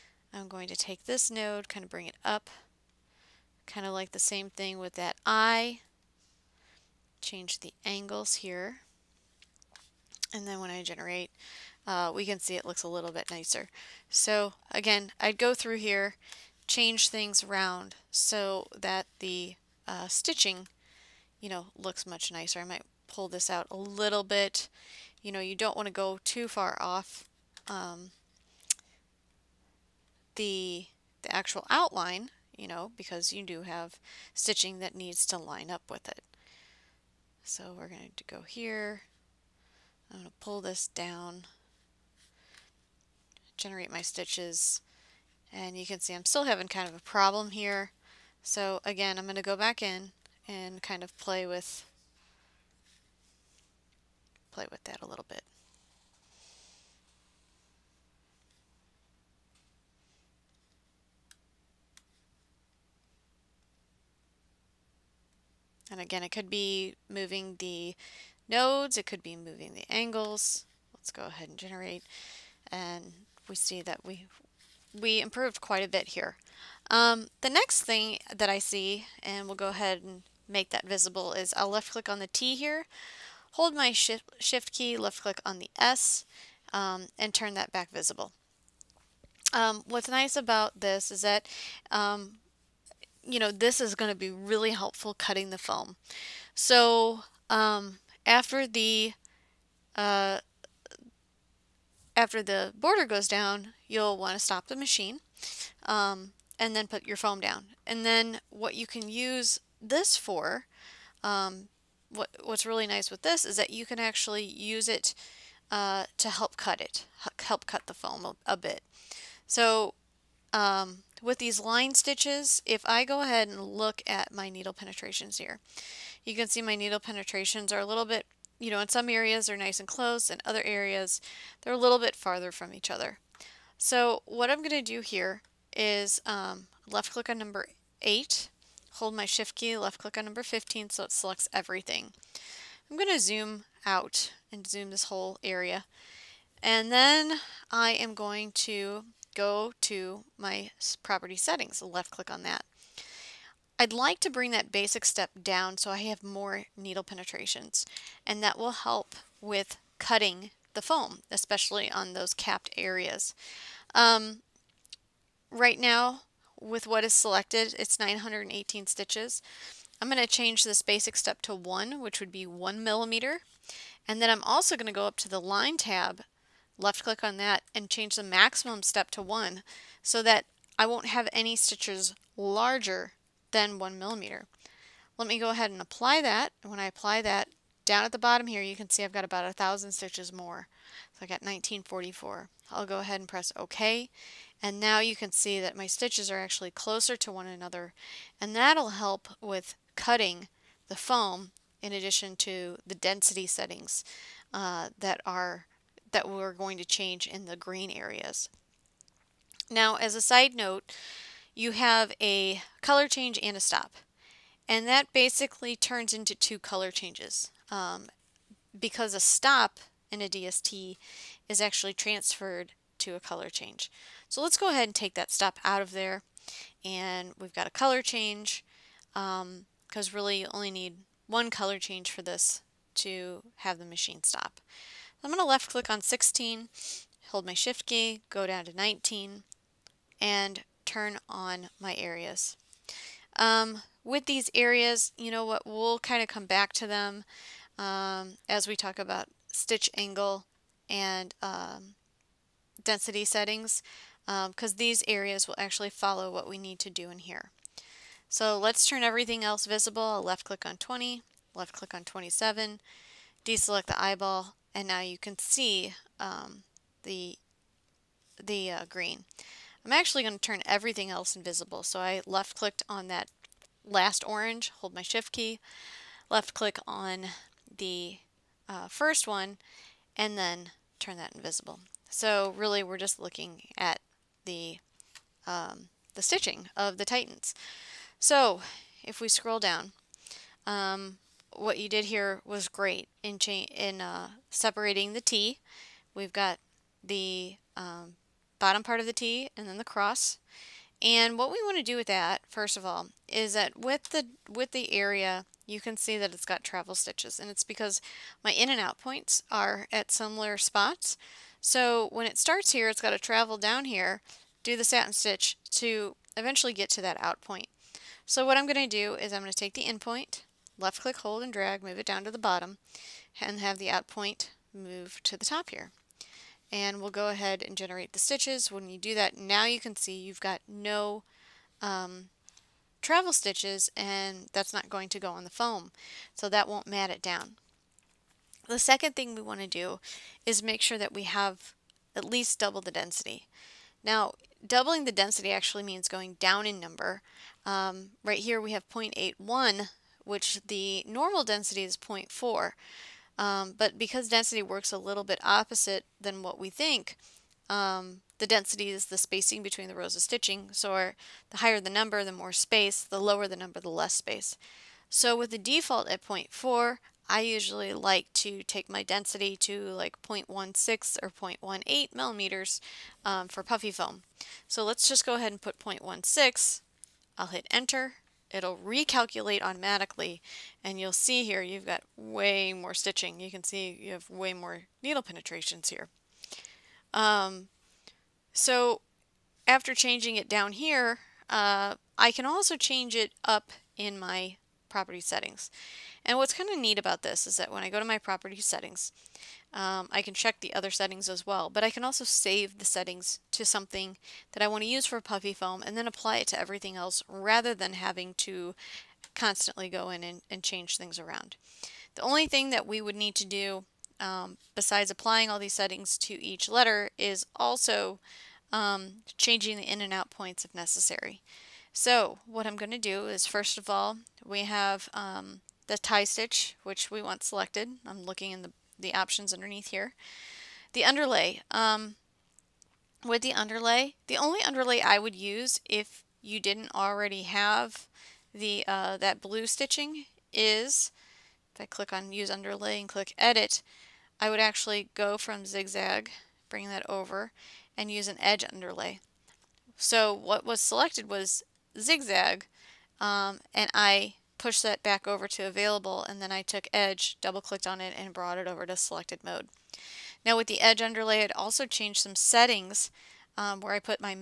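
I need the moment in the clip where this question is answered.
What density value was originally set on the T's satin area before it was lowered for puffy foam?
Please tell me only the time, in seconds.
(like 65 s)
348 s.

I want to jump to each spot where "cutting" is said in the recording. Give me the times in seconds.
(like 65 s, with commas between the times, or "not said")
95 s, 159 s, 199 s.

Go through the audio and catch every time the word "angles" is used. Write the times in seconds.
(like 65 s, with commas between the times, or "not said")
7 s, 69 s, 249 s.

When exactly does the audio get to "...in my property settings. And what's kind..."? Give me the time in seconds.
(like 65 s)
393 s.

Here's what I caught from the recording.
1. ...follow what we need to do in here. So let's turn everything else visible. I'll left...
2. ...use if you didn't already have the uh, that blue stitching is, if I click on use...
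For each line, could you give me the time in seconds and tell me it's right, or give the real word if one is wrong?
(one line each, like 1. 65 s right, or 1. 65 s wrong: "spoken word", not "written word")
1. 255 s right
2. 435 s right.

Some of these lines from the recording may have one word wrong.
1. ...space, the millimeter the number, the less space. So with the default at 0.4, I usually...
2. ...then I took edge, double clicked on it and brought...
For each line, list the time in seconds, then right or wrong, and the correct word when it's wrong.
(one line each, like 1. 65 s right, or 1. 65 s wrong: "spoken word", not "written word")
1. 362 s wrong: "lower", not "millimeter"
2. 456 s right.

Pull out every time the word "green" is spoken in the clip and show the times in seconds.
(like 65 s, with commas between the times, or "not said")
207 s, 268 s.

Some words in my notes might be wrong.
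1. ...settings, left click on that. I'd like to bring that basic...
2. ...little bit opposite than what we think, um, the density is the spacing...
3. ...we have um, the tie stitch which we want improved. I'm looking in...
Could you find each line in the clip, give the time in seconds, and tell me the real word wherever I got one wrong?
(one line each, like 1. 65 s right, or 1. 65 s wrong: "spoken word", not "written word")
1. 151 s right
2. 354 s right
3. 424 s wrong: "selected", not "improved".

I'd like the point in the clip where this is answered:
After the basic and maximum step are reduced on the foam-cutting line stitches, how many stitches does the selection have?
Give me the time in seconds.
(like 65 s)
191 s.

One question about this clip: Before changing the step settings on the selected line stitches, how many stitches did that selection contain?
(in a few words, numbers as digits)
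918.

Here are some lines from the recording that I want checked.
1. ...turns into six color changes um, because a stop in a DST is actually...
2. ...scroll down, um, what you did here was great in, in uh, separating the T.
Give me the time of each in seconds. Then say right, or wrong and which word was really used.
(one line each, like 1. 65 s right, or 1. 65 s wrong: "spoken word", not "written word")
1. 215 s wrong: "two", not "six"
2. 289 s right.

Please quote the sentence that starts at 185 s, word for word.
Let me go ahead and apply that.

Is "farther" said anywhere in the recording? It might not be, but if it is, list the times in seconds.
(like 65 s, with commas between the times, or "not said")
132 s.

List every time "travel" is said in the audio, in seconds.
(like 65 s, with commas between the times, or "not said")
306 s, 313 s, 333 s.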